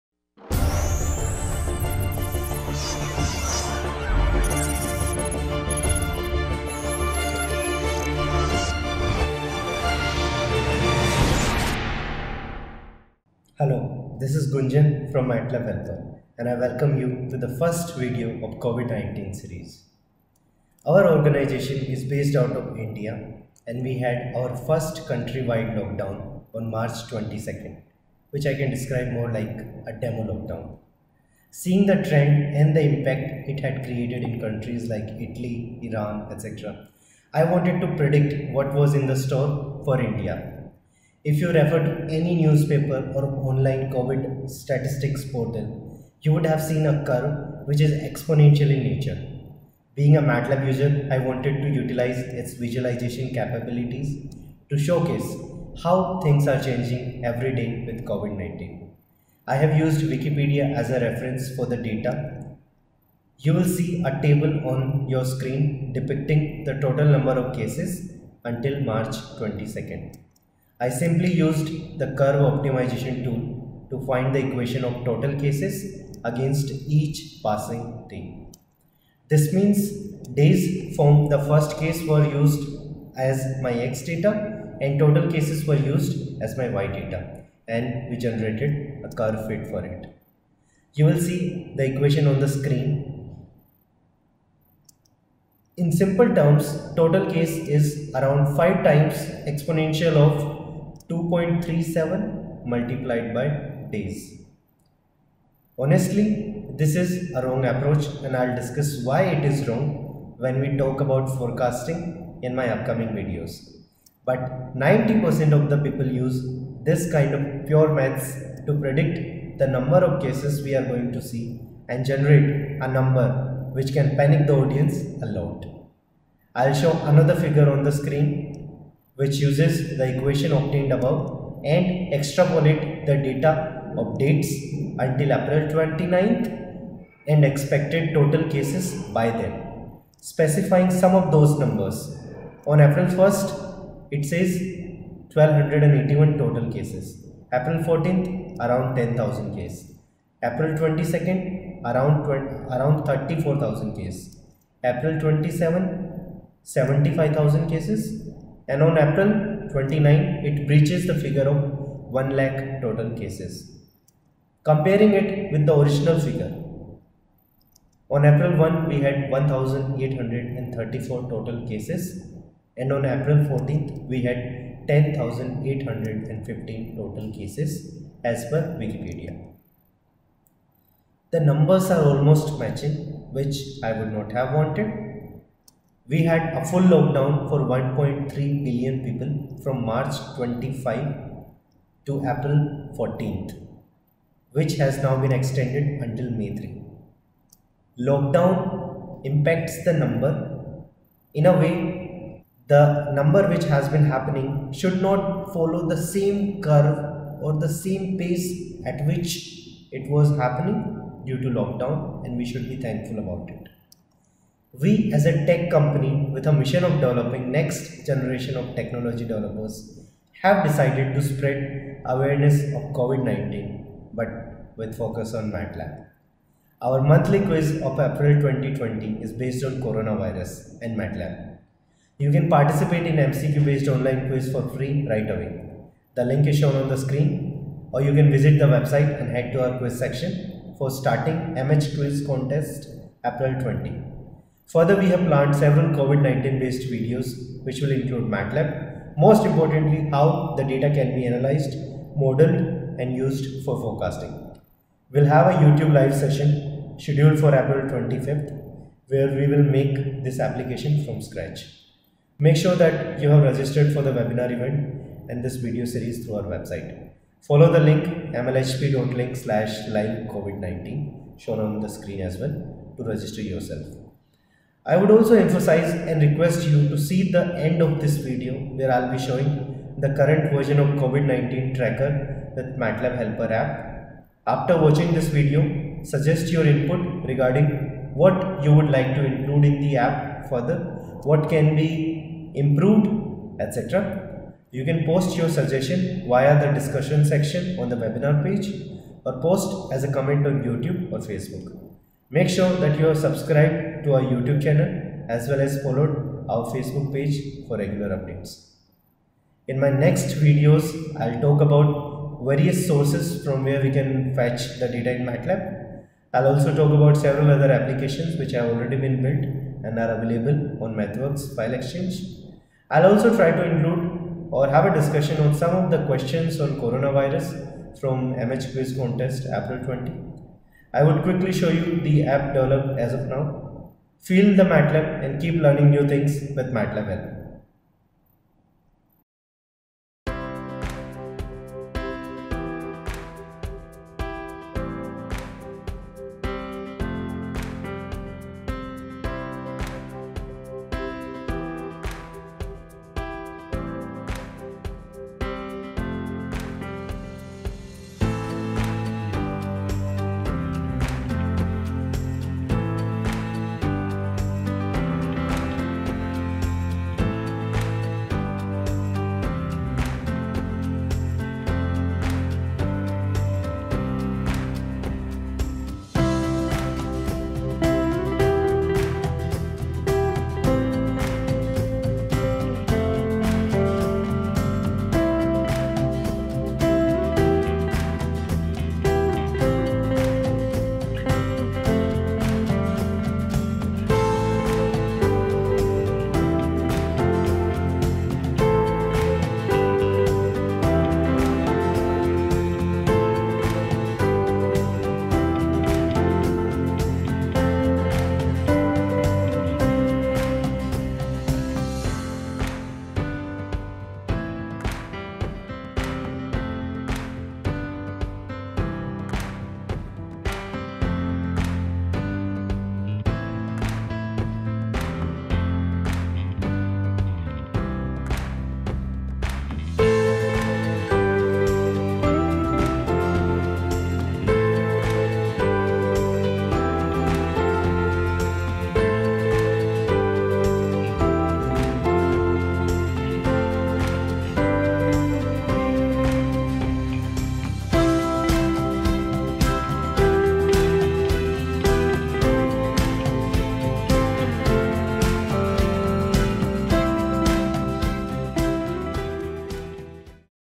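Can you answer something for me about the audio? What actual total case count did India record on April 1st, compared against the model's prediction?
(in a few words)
1834.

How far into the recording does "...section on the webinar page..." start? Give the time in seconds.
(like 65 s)
297 s.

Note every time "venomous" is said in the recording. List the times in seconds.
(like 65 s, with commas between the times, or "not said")
not said.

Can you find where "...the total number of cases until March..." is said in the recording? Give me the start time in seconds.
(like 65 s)
66 s.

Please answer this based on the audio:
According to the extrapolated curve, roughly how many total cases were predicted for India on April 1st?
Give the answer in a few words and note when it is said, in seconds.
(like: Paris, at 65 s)
1281, at 144 s.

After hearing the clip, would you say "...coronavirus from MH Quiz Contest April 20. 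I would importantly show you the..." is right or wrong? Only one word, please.
wrong.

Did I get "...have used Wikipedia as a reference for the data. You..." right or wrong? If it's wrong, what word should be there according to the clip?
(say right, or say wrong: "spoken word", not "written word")
right.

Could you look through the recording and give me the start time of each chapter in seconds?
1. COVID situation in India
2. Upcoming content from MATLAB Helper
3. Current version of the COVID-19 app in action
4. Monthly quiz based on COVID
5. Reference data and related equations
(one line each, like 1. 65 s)
1. 12 s
2. 273 s
3. 339 s
4. 226 s
5. 59 s.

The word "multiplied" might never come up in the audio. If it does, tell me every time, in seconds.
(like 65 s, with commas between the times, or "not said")
102 s.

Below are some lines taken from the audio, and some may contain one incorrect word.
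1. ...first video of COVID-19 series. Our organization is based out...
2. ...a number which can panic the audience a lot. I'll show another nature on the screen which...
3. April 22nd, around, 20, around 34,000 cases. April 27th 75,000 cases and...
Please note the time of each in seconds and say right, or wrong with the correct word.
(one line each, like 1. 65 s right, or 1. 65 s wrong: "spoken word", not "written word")
1. 17 s right
2. 122 s wrong: "figure", not "nature"
3. 150 s right.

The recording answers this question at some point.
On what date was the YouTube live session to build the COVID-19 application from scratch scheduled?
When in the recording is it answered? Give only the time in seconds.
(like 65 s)
257 s.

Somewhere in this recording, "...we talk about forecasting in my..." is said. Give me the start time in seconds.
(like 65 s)
110 s.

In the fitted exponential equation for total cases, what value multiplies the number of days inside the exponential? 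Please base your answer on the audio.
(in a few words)
2.37.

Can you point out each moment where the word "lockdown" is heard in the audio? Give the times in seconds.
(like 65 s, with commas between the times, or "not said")
25 s, 30 s, 186 s, 198 s, 211 s.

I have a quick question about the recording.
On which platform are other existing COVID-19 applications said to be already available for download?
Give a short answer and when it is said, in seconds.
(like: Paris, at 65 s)
MathWorks File Exchange, at 320 s.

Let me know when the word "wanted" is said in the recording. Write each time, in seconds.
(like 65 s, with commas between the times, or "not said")
37 s, 51 s, 184 s.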